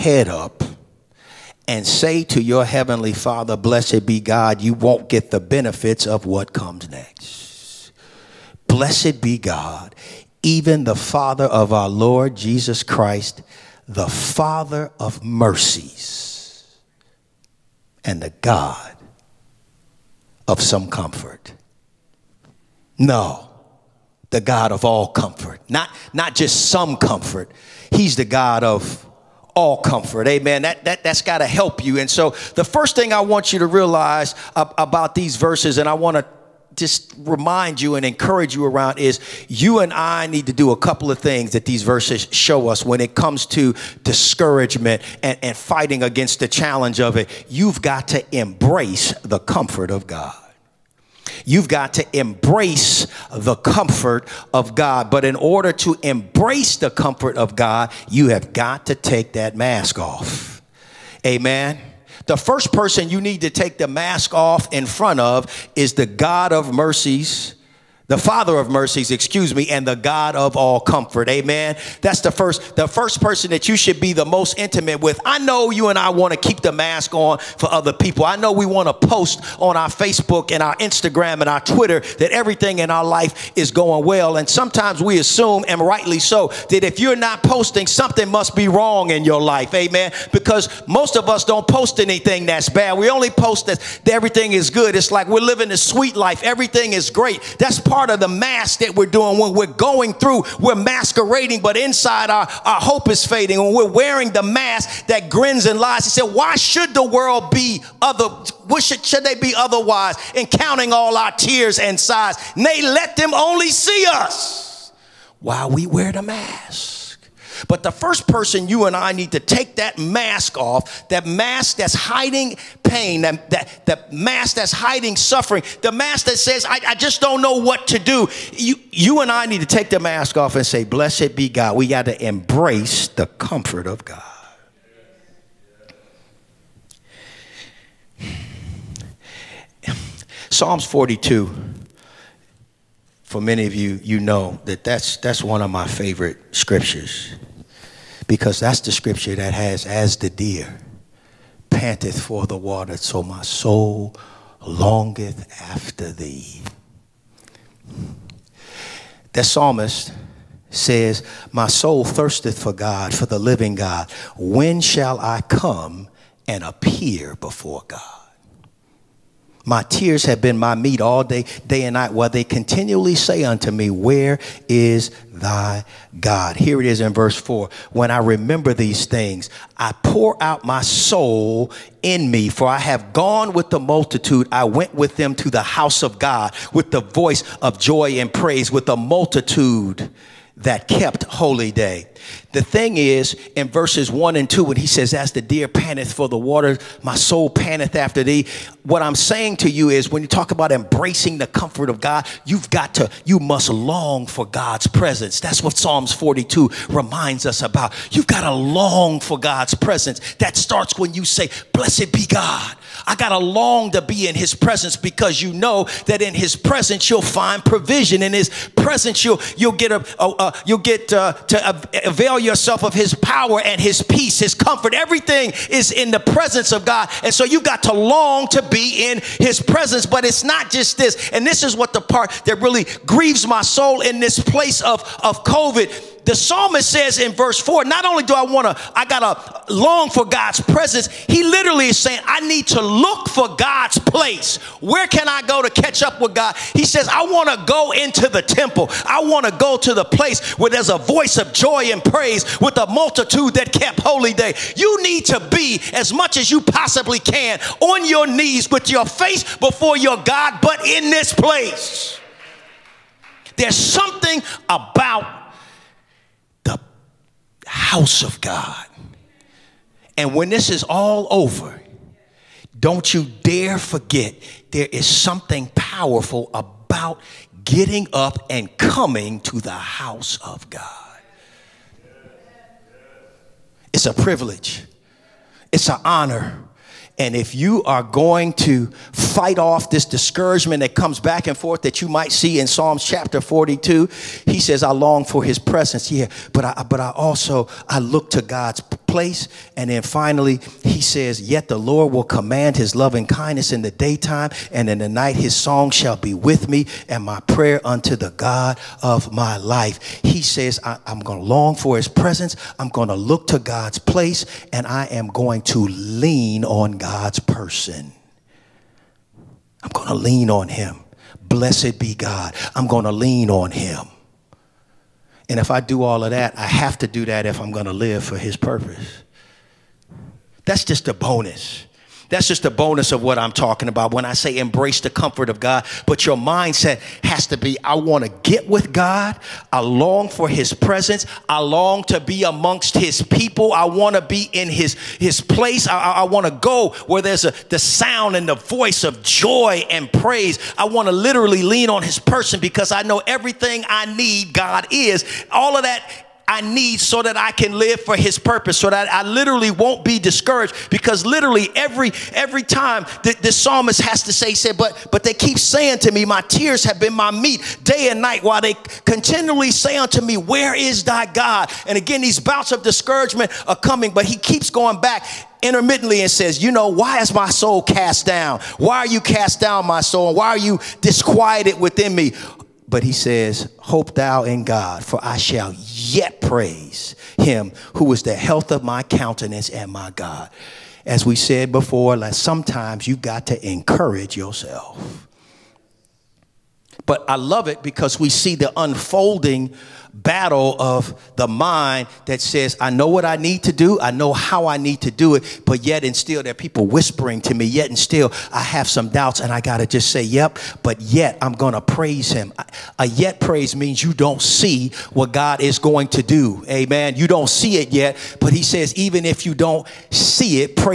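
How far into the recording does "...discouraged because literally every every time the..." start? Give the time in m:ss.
6:00.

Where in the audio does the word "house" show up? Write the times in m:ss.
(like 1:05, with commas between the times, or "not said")
3:05, 4:27, 4:39.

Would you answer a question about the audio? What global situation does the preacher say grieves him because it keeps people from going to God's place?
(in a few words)
COVID.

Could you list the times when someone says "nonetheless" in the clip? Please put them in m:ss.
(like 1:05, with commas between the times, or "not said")
not said.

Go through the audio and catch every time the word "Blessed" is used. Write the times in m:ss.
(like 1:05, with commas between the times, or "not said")
0:03, 0:08, 2:10, 3:31, 5:21.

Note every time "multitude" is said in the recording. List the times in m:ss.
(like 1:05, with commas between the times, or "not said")
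3:03, 3:08, 4:12.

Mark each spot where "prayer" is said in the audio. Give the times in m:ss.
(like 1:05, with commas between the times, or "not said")
5:07.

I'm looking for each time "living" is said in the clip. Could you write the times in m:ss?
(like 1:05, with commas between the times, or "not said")
1:35, 2:43.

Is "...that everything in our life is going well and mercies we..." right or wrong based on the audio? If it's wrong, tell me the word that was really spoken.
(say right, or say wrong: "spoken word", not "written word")
wrong: "sometimes", not "mercies".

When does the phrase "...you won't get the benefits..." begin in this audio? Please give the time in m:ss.
0:04.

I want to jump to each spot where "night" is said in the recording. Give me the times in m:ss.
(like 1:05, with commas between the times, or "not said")
2:51, 5:05, 6:08.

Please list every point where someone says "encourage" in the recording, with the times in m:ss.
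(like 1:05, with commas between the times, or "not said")
0:38, 6:33.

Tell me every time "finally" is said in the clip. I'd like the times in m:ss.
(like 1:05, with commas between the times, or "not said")
5:00.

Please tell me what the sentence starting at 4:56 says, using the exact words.
Yeah, but I, but I also, I look to God's place.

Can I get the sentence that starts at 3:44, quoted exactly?
Everything is in the presence of God.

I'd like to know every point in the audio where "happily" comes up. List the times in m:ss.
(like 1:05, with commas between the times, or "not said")
not said.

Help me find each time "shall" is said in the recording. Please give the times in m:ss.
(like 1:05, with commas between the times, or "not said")
2:44, 5:05, 6:25.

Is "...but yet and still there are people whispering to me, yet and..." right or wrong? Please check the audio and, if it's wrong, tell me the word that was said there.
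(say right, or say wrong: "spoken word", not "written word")
right.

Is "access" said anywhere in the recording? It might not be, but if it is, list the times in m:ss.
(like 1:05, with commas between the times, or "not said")
not said.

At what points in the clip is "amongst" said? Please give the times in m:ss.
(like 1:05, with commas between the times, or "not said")
5:42.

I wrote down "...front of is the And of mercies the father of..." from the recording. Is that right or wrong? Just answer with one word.
wrong.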